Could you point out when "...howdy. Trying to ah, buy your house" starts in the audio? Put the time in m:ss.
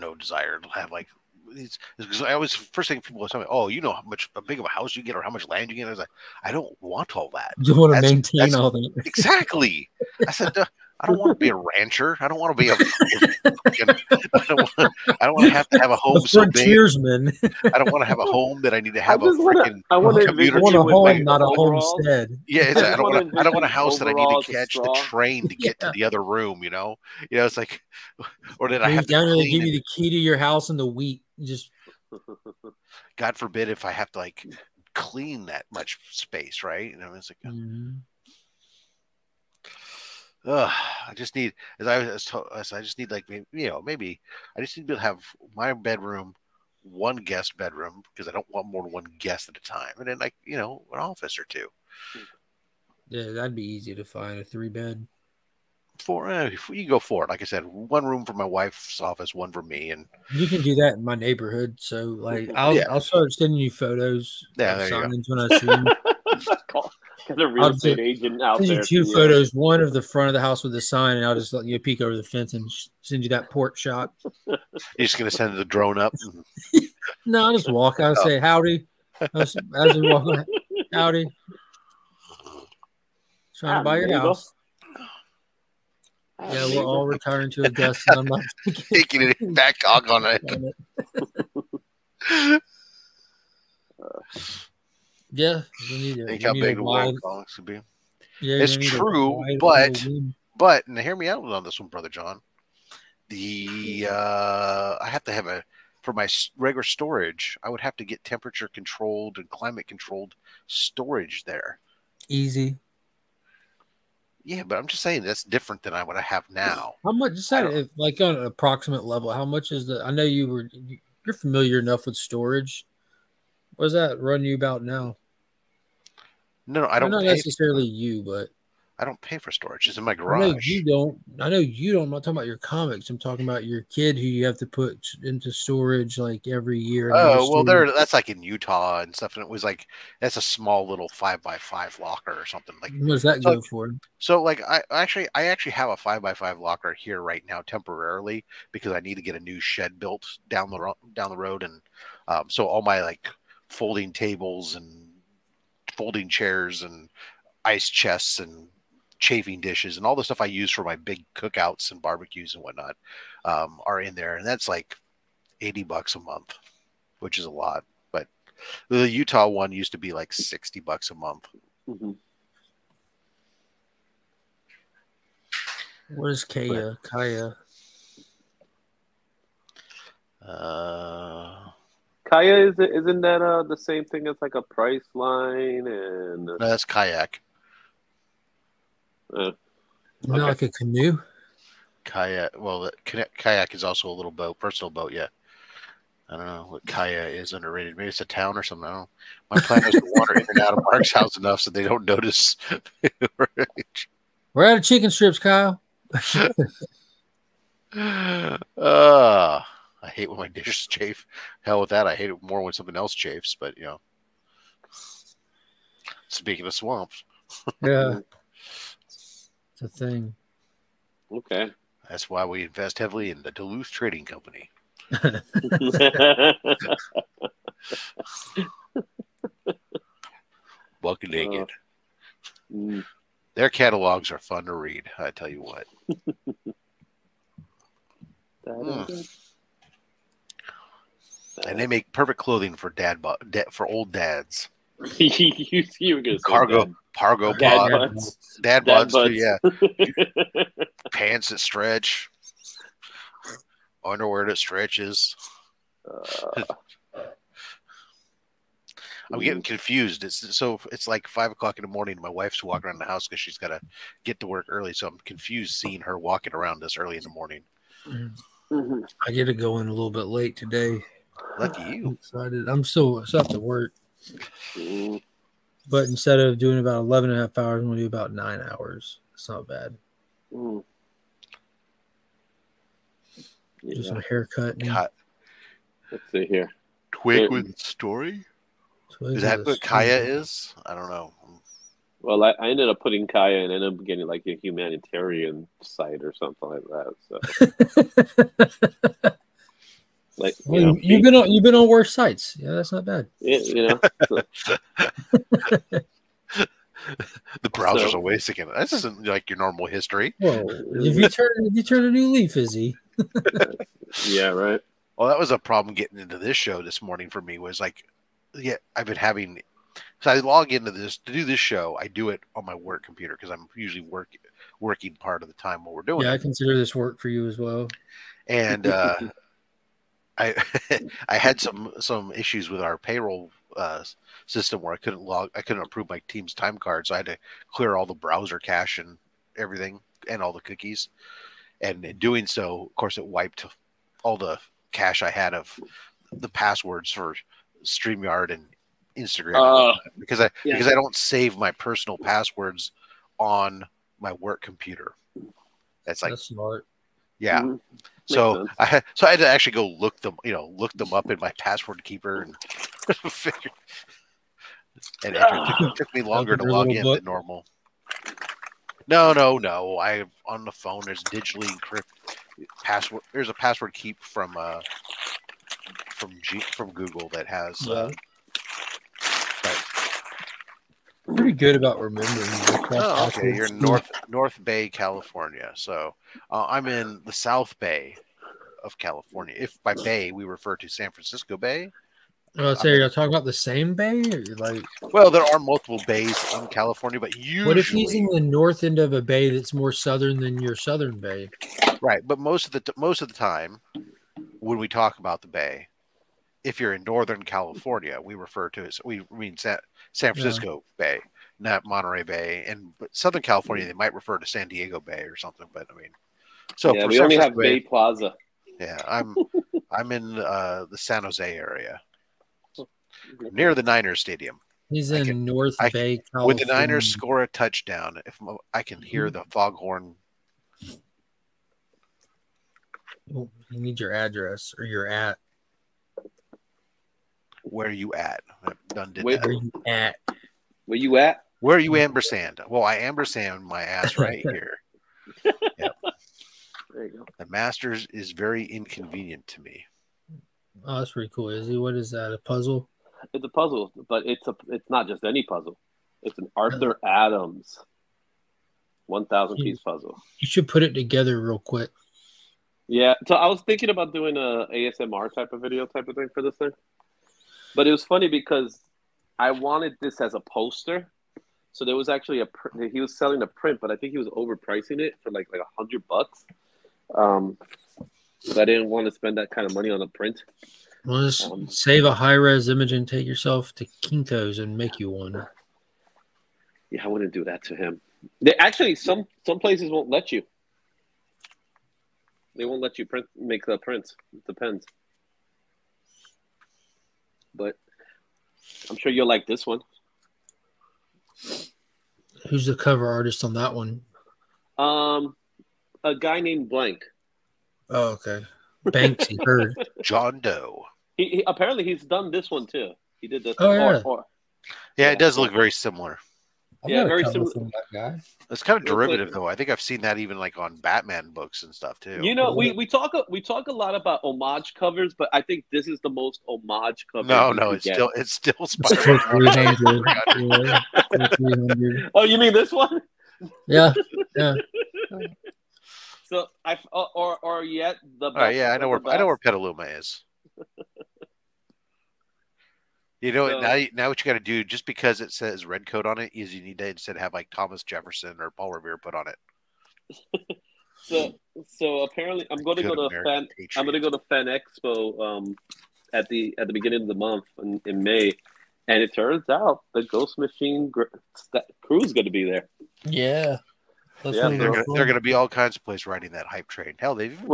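1:20.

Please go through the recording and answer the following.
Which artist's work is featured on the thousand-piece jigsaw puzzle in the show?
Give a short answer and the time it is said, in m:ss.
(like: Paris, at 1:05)
Arthur Adams, at 7:36.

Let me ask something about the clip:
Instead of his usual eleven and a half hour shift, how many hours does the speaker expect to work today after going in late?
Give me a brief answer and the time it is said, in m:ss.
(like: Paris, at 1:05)
9, at 4:38.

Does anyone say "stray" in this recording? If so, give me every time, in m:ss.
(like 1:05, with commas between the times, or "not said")
not said.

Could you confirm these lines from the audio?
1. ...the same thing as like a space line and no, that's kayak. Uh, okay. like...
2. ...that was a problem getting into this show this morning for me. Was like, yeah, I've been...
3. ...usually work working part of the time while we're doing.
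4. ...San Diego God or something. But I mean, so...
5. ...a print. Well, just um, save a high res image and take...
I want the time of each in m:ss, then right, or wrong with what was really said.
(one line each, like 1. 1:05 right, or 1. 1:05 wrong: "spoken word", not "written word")
1. 3:03 wrong: "price", not "space"
2. 5:15 right
3. 5:23 right
4. 6:54 wrong: "Bay", not "God"
5. 8:00 right.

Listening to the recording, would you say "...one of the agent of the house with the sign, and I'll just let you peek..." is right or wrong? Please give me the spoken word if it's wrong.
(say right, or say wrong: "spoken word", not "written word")
wrong: "front", not "agent".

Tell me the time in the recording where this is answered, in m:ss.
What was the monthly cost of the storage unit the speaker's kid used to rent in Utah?
2:50.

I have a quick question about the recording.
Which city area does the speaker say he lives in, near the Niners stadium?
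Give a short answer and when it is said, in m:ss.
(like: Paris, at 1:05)
San Jose, at 7:00.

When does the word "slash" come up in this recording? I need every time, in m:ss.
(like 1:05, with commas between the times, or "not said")
not said.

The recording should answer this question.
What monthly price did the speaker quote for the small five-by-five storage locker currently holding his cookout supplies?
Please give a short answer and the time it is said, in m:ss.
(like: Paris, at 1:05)
$80, at 2:45.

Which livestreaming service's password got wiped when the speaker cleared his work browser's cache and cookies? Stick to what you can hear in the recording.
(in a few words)
Streamyard.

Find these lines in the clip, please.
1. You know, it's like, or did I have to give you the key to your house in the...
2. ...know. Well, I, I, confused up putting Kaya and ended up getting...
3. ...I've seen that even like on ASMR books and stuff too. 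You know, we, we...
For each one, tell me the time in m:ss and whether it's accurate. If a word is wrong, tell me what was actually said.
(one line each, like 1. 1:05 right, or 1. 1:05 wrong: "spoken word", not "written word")
1. 0:27 right
2. 4:51 wrong: "ended", not "confused"
3. 8:39 wrong: "Batman", not "ASMR".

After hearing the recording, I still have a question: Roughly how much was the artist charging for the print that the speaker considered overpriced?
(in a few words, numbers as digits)
$100.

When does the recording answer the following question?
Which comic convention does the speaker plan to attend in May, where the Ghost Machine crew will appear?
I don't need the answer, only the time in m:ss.
9:14.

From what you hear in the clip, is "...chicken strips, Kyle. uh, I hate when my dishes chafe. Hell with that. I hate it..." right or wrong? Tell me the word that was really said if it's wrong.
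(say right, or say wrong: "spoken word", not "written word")
right.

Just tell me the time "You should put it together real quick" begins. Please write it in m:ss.
7:40.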